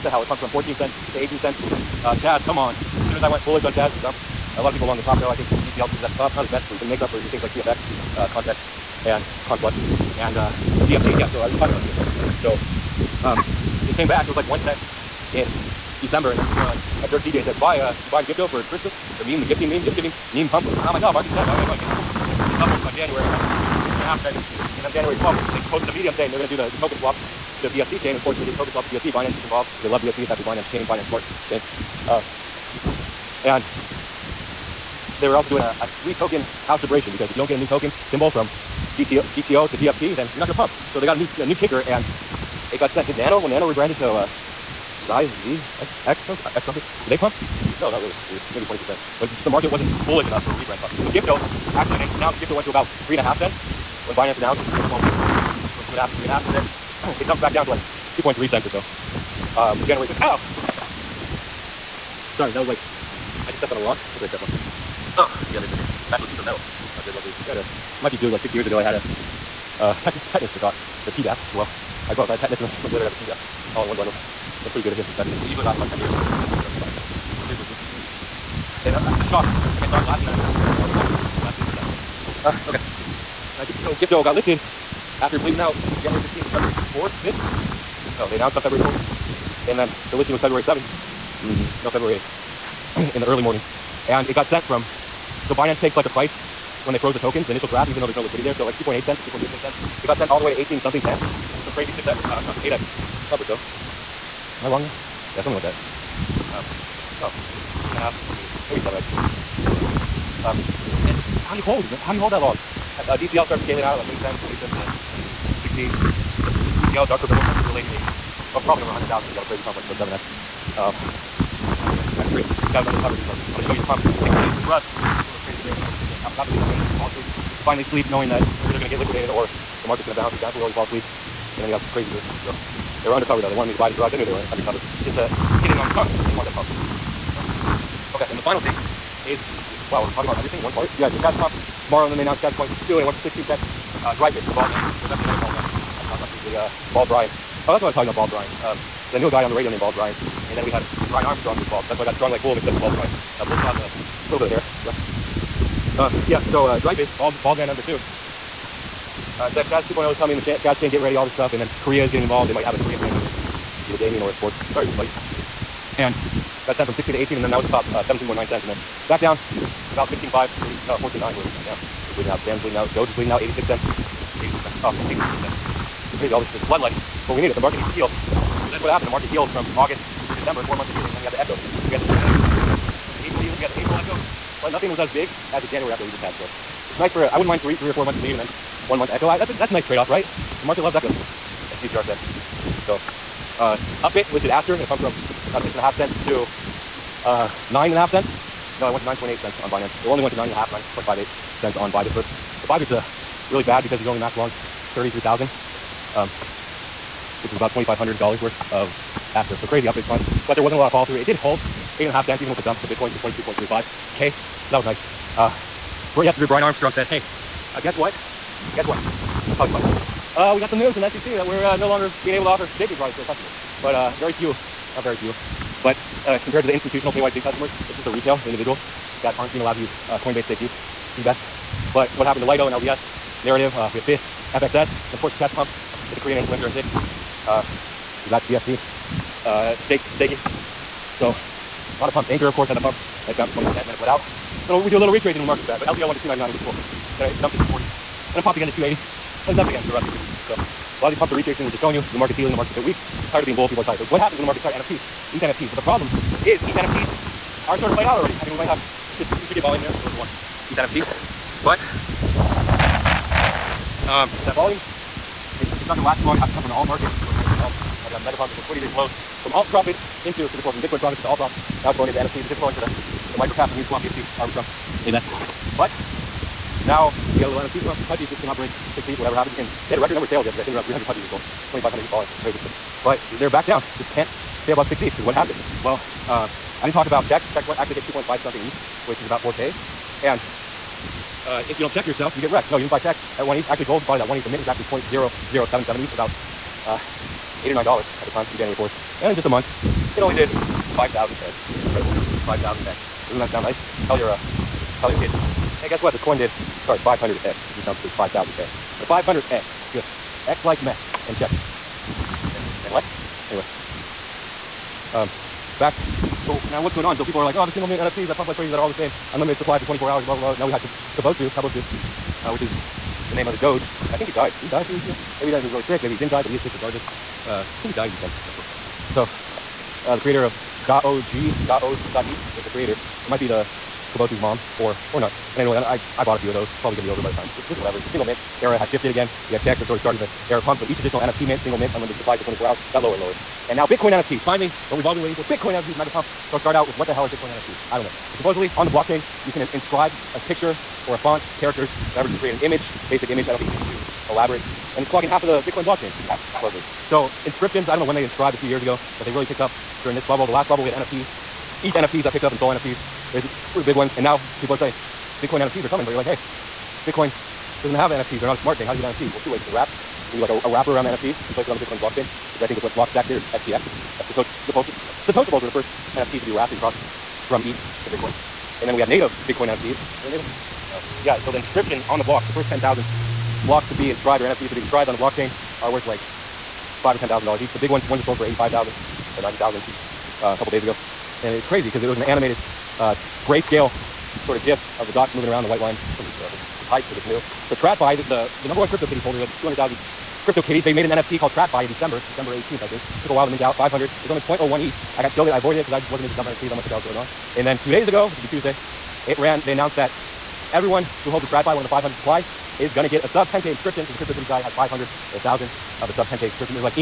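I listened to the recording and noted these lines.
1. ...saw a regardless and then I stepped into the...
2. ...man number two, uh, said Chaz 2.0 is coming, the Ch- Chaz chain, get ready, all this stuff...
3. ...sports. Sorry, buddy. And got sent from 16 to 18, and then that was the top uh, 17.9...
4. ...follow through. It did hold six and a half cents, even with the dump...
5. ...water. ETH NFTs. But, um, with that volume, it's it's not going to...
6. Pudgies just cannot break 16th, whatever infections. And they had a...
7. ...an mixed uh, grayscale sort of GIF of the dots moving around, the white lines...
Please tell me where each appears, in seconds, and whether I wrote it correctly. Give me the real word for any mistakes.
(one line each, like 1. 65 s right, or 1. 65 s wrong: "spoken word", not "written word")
1. 79 s wrong: "glass", not "regardless"
2. 157 s right
3. 164 s right
4. 210 s wrong: "eight", not "six"
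5. 260 s right
6. 278 s wrong: "happens", not "infections"
7. 392 s wrong: "animated", not "mixed".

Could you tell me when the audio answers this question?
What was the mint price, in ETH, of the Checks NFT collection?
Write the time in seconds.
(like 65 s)
294 s.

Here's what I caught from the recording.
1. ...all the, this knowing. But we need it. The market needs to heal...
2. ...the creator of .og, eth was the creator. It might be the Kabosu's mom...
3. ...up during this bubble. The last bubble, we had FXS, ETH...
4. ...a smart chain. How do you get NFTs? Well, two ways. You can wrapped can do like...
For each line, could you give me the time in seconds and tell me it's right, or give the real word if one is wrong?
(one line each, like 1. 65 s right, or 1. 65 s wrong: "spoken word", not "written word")
1. 176 s wrong: "bloodletting", not "knowing"
2. 330 s right
3. 359 s wrong: "NFT", not "FXS"
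4. 368 s right.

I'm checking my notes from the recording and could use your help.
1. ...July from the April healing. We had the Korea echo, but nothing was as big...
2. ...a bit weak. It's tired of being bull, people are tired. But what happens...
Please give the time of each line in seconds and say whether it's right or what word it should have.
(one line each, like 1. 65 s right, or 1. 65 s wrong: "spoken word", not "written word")
1. 182 s wrong: "April", not "Korea"
2. 252 s right.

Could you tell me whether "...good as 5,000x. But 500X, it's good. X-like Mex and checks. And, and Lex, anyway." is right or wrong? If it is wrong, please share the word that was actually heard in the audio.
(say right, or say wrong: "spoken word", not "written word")
right.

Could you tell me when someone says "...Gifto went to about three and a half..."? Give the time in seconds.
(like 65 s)
52 s.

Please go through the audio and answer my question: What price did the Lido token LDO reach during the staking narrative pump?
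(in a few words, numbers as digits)
299.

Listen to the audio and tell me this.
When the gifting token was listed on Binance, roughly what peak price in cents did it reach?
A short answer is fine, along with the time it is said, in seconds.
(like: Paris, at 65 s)
18 cents, at 100 s.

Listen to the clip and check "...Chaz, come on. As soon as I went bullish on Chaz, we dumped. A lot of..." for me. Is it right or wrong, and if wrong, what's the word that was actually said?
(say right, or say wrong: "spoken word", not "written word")
right.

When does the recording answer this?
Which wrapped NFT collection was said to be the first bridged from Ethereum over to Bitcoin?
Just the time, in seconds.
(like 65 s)
374 s.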